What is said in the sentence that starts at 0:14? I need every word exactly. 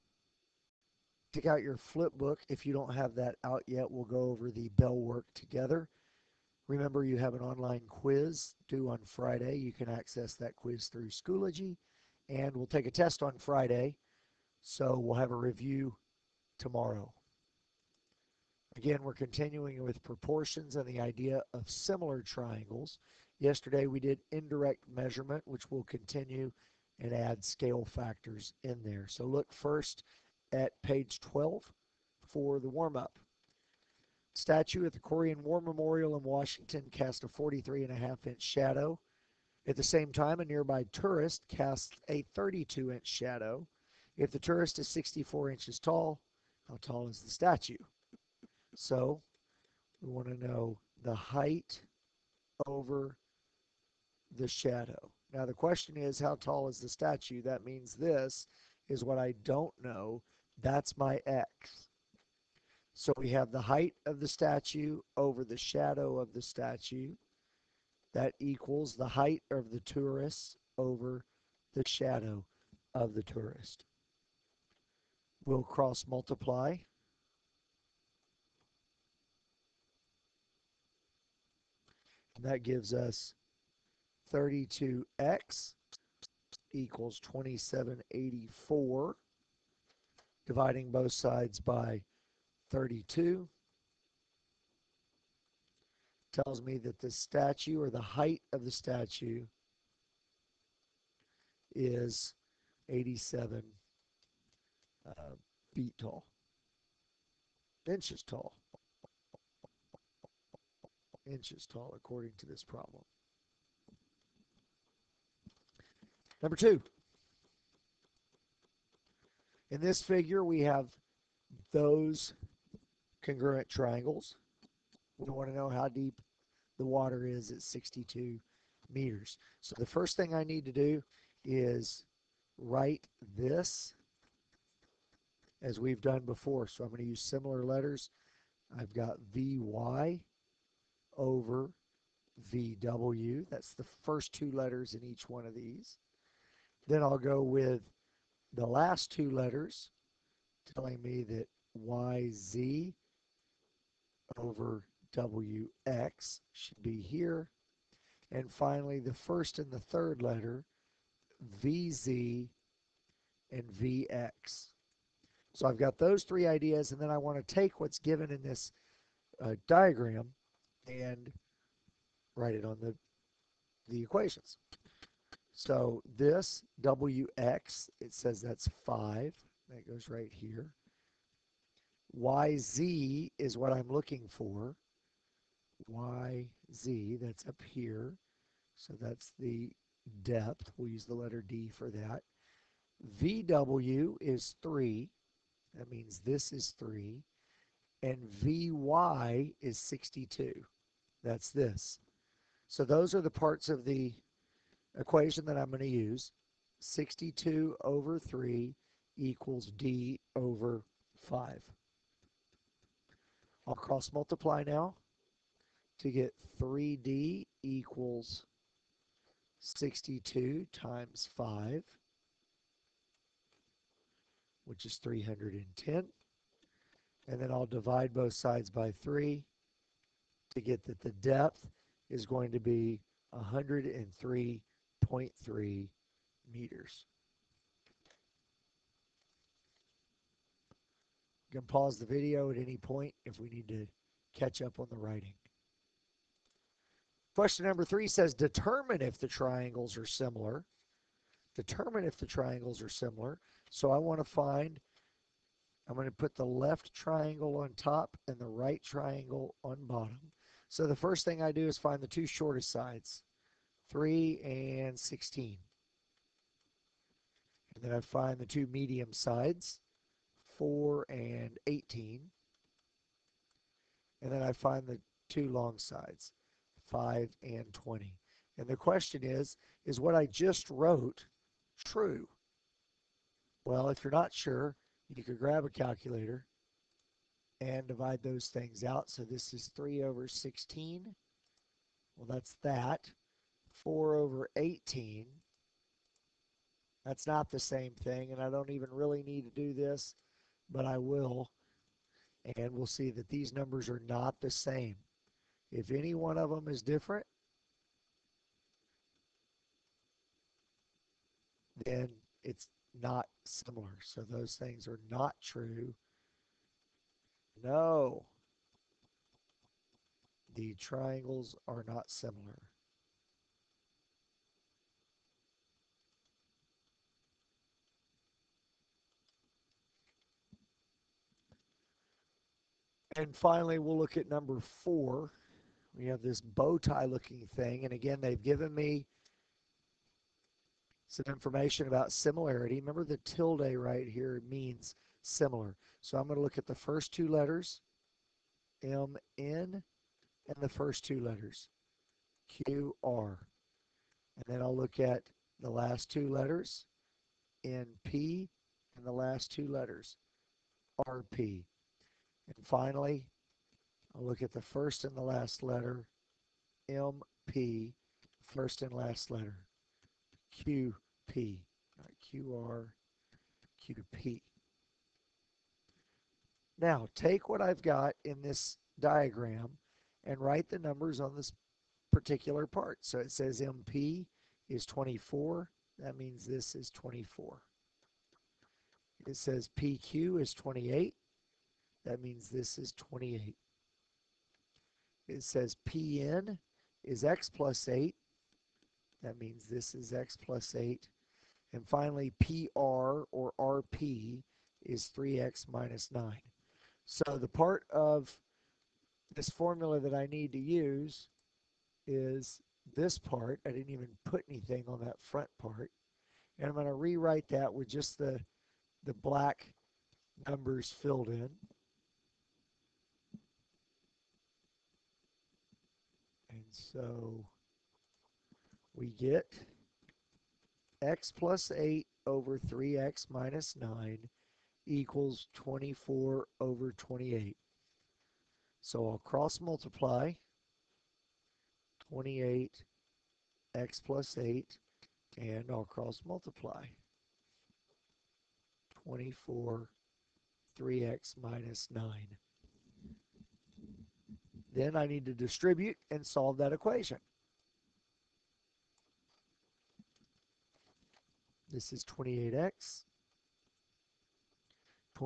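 So we'll have a review tomorrow.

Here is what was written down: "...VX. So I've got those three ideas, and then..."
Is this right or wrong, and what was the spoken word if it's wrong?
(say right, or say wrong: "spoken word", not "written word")
right.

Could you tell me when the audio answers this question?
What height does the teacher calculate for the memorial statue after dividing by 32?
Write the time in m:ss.
1:42.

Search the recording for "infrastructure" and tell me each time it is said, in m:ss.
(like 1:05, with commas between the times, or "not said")
not said.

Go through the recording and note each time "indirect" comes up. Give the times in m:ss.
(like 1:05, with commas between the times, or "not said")
0:24.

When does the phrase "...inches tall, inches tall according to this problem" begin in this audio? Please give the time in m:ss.
1:47.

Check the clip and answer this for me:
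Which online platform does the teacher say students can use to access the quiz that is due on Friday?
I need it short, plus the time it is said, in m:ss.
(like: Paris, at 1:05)
Schoology, at 0:11.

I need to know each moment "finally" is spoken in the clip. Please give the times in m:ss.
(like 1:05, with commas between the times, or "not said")
2:38, 5:33, 6:02, 6:41.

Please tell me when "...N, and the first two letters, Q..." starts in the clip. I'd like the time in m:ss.
5:49.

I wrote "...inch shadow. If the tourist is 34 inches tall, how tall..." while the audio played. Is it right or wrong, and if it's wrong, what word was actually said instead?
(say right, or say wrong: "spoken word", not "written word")
wrong: "64", not "34".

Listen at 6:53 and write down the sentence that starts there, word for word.
I didn't even put anything on that front part.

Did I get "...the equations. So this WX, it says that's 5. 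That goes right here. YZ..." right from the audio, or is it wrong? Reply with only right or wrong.
right.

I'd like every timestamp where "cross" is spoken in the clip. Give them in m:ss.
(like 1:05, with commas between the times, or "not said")
1:15, 3:33, 7:19, 7:25.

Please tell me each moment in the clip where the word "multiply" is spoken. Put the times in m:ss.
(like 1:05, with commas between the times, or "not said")
1:16, 3:34, 7:19, 7:26.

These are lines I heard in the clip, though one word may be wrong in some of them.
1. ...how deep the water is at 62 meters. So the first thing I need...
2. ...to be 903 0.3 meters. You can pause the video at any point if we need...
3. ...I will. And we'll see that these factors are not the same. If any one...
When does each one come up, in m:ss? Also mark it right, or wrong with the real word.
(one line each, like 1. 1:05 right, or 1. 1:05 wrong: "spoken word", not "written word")
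1. 2:05 right
2. 3:52 wrong: "103", not "903"
3. 5:00 wrong: "numbers", not "factors".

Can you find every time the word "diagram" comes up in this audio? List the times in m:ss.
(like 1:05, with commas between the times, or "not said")
2:49, 6:18.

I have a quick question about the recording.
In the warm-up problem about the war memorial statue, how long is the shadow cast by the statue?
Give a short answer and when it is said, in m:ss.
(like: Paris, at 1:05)
43.5 inches, at 0:37.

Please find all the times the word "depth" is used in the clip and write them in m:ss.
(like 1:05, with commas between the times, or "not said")
3:10, 3:51.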